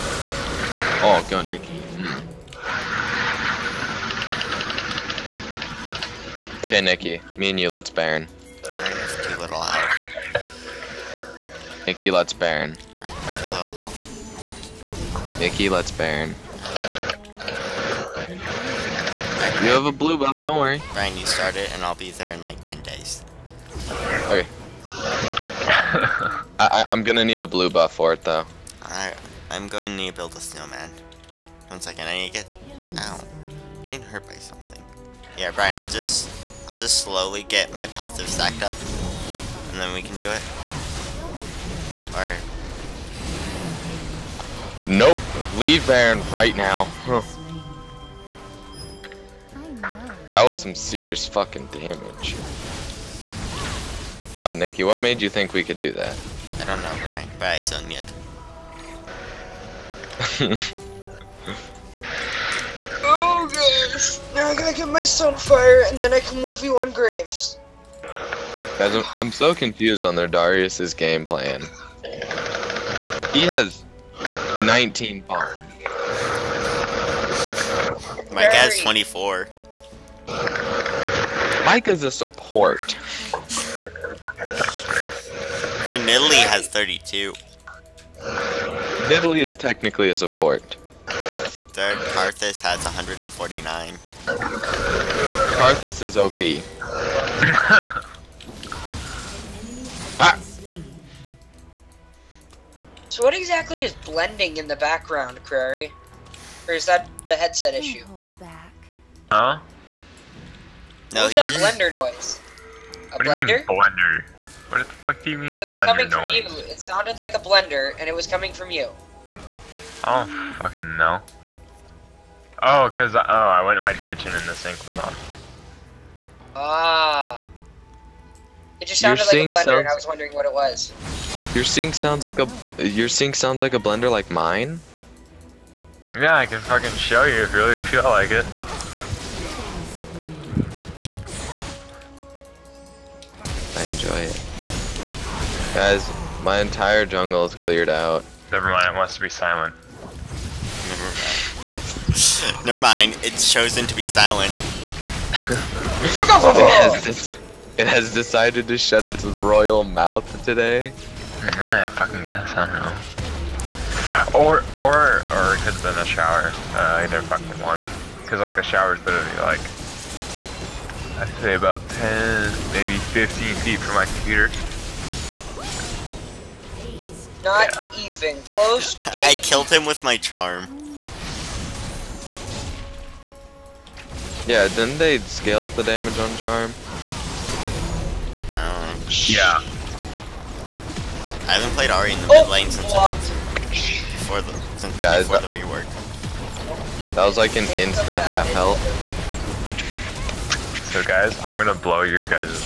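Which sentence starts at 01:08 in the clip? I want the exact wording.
Guys, I'm, I'm so confused on their Darius's game plan.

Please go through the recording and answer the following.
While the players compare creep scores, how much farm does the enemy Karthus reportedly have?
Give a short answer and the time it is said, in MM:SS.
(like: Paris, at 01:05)
149, at 01:32.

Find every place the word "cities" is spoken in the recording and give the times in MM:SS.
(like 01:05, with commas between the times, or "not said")
not said.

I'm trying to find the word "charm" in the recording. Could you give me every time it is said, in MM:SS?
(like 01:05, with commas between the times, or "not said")
03:00, 03:06.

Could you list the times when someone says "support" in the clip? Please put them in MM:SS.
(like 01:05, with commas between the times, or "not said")
01:22, 01:30.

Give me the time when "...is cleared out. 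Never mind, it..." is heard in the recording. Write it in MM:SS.
02:27.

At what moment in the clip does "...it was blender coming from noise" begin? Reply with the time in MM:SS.
01:55.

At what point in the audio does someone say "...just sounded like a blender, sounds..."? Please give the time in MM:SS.
02:08.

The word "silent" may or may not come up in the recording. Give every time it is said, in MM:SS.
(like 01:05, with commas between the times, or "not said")
02:29, 02:34.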